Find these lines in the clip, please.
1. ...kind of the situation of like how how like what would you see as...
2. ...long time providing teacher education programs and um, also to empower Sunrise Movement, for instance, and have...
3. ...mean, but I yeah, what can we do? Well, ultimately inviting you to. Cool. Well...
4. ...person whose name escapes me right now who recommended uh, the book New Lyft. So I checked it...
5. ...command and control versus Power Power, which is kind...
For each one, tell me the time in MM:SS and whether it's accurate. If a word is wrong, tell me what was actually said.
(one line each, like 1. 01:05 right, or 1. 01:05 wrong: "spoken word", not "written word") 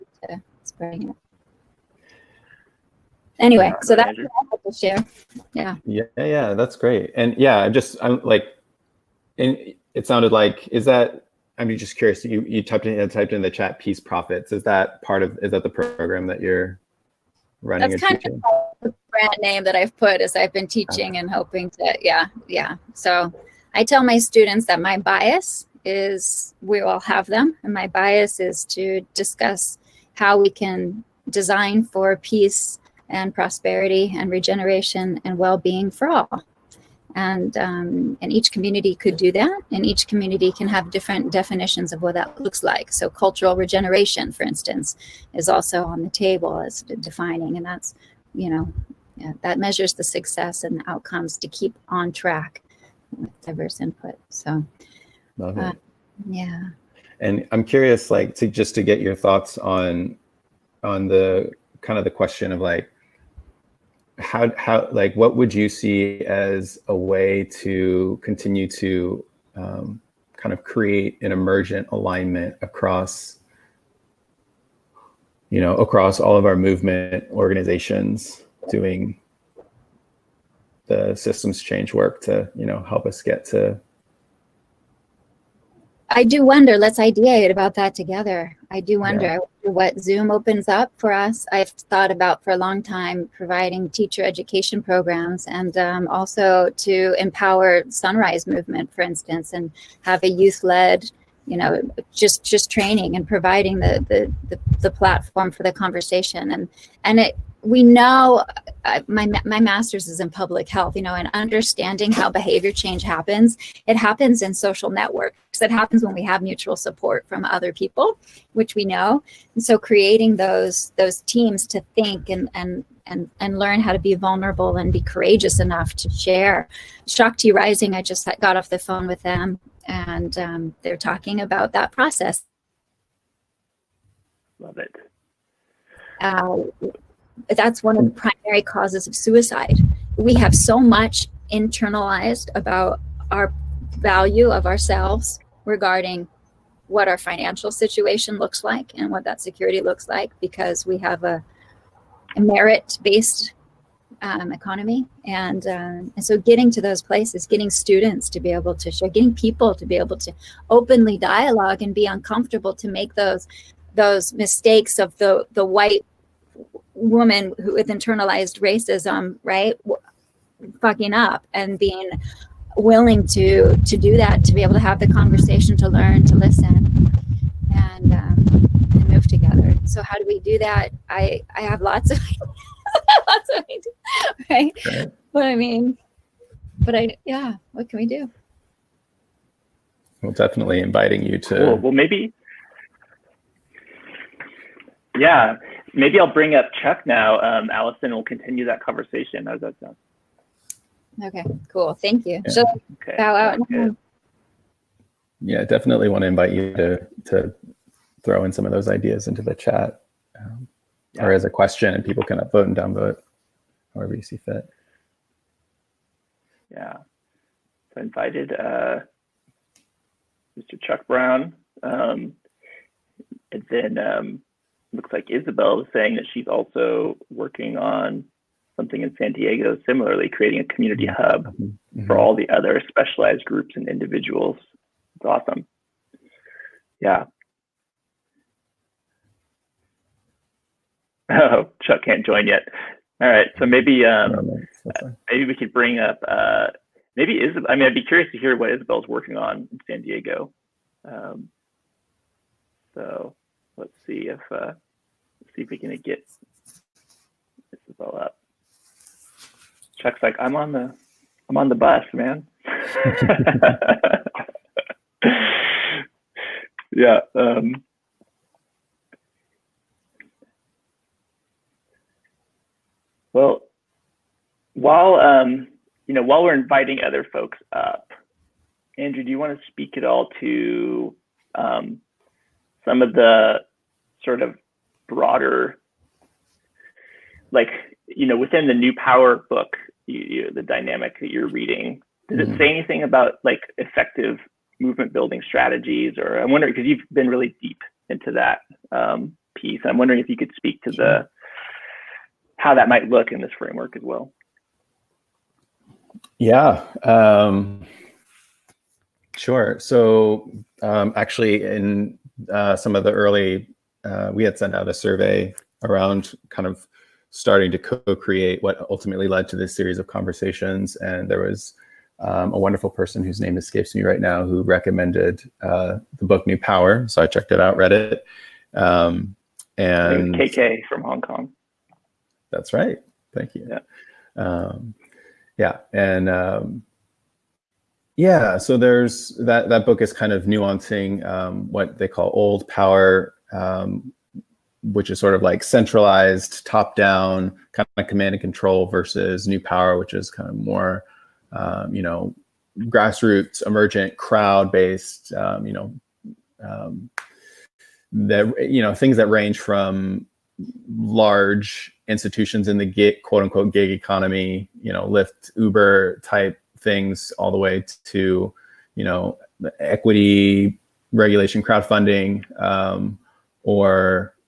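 1. 01:01 wrong: "question", not "situation"
2. 01:32 right
3. 03:05 wrong: "definitely", not "ultimately"
4. 05:22 wrong: "Power", not "Lyft"
5. 05:48 wrong: "New", not "Power".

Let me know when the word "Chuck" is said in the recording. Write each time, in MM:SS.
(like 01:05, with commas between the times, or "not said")
03:16, 03:40, 04:01, 04:19.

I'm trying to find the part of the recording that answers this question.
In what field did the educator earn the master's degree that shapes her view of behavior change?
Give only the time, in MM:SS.
01:50.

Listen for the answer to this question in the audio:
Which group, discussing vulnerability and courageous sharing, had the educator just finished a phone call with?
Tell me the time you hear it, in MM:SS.
02:07.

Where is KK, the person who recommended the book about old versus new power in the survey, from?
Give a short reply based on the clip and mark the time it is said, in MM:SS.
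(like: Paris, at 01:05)
Hong Kong, at 05:31.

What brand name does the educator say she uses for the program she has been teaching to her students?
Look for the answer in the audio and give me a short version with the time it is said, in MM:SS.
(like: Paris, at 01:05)
Peace profits, at 00:13.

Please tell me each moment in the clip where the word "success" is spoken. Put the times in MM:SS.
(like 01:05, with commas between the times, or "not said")
00:50.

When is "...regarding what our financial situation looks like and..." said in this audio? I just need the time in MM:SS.
02:25.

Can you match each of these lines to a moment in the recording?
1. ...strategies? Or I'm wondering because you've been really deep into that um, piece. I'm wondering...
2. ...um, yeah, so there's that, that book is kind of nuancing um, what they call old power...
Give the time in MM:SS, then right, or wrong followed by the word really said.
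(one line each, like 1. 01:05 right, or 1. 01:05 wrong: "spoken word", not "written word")
1. 04:55 right
2. 05:36 right.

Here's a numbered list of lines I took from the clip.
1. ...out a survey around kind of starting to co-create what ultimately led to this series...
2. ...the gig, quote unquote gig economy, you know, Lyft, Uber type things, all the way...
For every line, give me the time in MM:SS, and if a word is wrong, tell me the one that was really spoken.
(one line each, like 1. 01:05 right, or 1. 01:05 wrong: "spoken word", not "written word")
1. 05:14 right
2. 06:02 right.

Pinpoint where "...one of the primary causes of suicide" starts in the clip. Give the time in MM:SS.
02:17.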